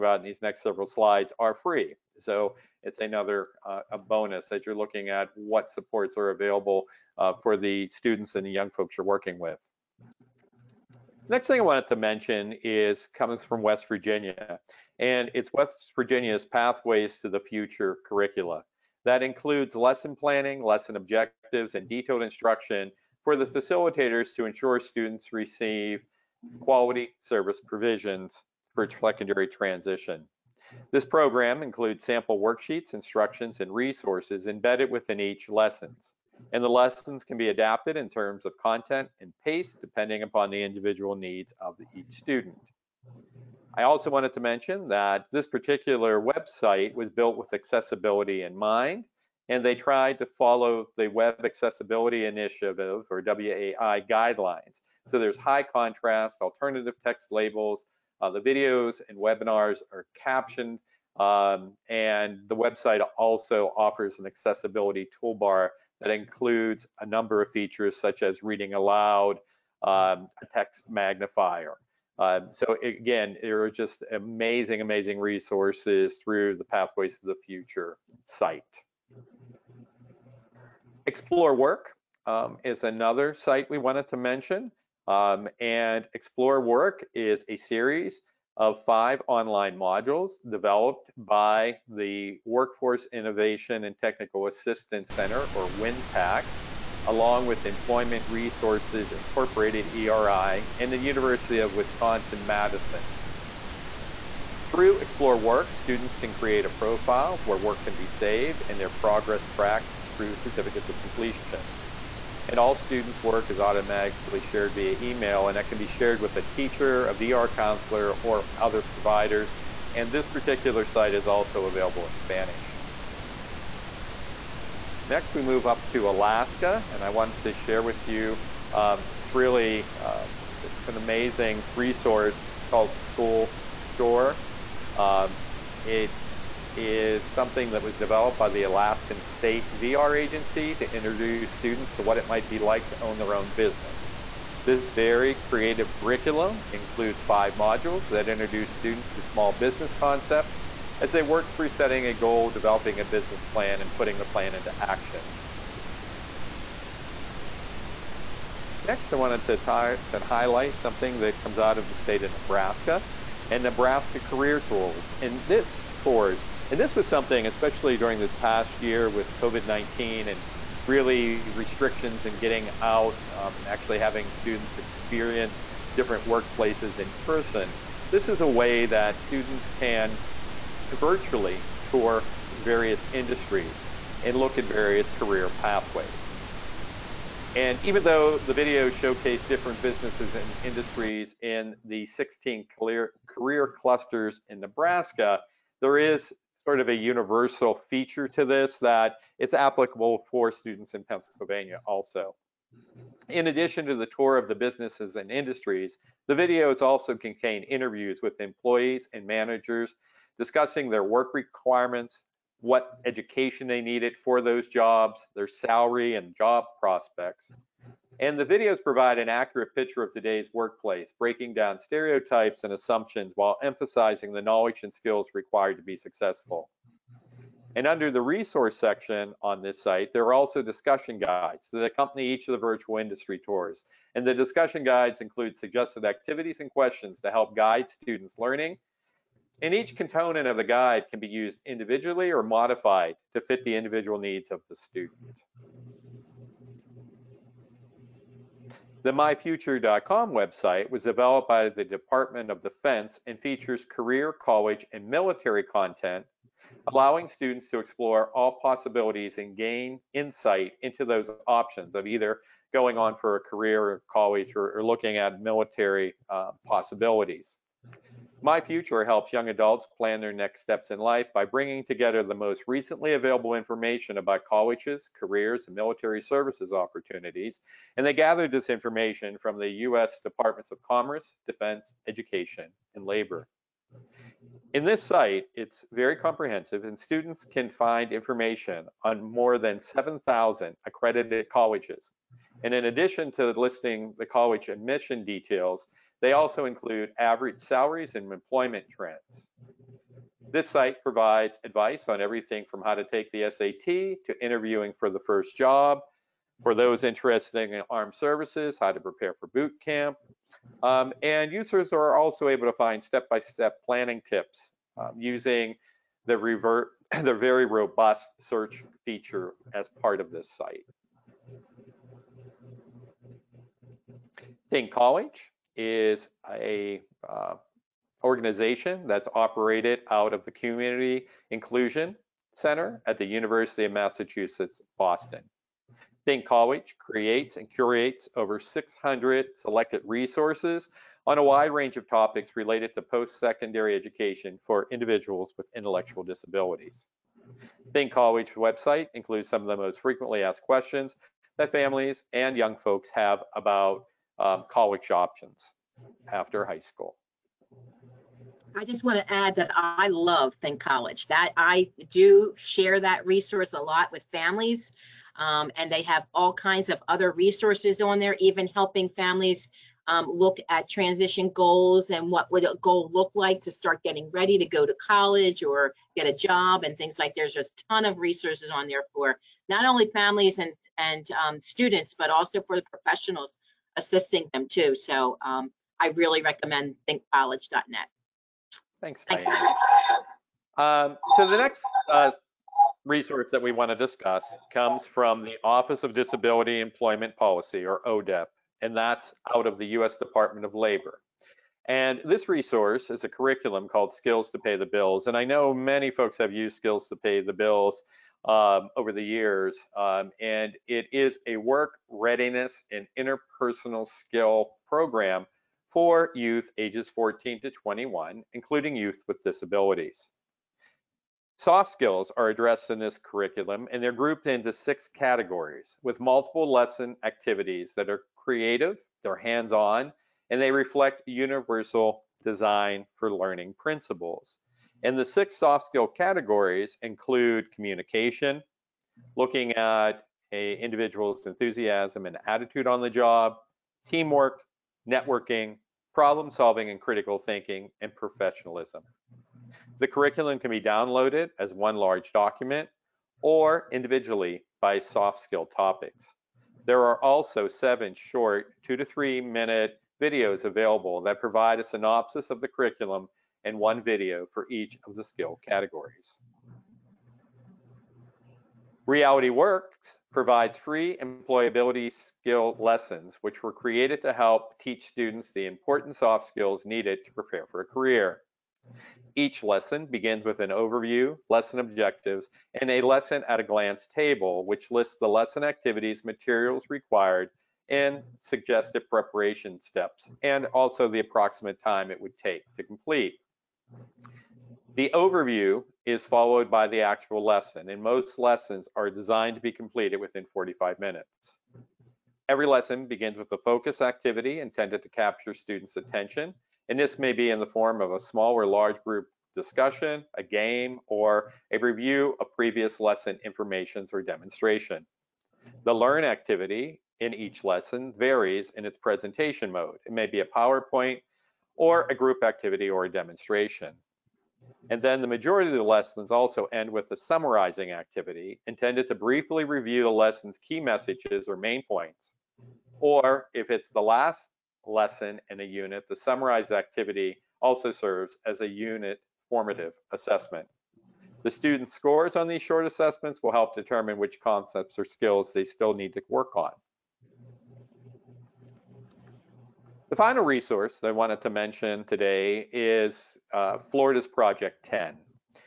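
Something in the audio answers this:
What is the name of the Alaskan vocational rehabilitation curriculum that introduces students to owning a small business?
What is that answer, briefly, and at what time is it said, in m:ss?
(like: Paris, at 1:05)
School Store, at 2:12.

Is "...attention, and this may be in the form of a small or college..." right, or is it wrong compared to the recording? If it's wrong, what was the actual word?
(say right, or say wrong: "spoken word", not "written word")
wrong: "large", not "college".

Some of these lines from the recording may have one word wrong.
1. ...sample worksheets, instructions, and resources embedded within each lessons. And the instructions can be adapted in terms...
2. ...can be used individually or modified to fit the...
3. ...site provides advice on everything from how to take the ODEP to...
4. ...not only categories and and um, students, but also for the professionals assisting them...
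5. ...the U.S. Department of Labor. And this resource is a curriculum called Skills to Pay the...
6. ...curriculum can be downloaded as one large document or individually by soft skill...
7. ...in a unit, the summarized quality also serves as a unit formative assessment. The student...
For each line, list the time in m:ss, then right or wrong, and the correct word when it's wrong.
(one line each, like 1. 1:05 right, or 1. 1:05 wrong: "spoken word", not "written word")
1. 0:32 wrong: "lessons", not "instructions"
2. 4:01 right
3. 5:00 wrong: "SAT", not "ODEP"
4. 6:19 wrong: "families", not "categories"
5. 6:39 right
6. 7:30 right
7. 8:55 wrong: "activity", not "quality".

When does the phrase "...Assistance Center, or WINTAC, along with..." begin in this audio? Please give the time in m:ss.
1:34.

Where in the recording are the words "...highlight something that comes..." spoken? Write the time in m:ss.
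2:40.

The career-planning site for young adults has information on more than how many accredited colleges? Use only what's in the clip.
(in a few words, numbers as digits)
7,000.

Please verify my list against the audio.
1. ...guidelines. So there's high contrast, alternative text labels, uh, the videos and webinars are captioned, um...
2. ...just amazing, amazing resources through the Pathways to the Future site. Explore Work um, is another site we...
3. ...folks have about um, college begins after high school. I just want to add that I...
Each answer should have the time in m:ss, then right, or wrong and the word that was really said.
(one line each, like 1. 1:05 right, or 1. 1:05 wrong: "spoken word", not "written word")
1. 0:54 right
2. 1:13 right
3. 5:52 wrong: "options", not "begins".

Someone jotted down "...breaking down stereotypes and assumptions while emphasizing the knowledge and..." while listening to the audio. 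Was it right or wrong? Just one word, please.
right.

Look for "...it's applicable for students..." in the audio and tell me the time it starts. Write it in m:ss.
3:19.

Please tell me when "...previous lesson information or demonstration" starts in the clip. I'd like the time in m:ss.
8:32.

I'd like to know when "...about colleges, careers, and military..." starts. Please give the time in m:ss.
4:34.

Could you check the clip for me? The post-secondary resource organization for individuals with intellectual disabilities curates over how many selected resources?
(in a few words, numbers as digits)
600.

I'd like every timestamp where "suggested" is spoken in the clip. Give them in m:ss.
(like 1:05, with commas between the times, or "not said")
3:55, 8:08.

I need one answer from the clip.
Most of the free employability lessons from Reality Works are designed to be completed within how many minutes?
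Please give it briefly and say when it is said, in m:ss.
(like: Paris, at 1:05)
45, at 8:20.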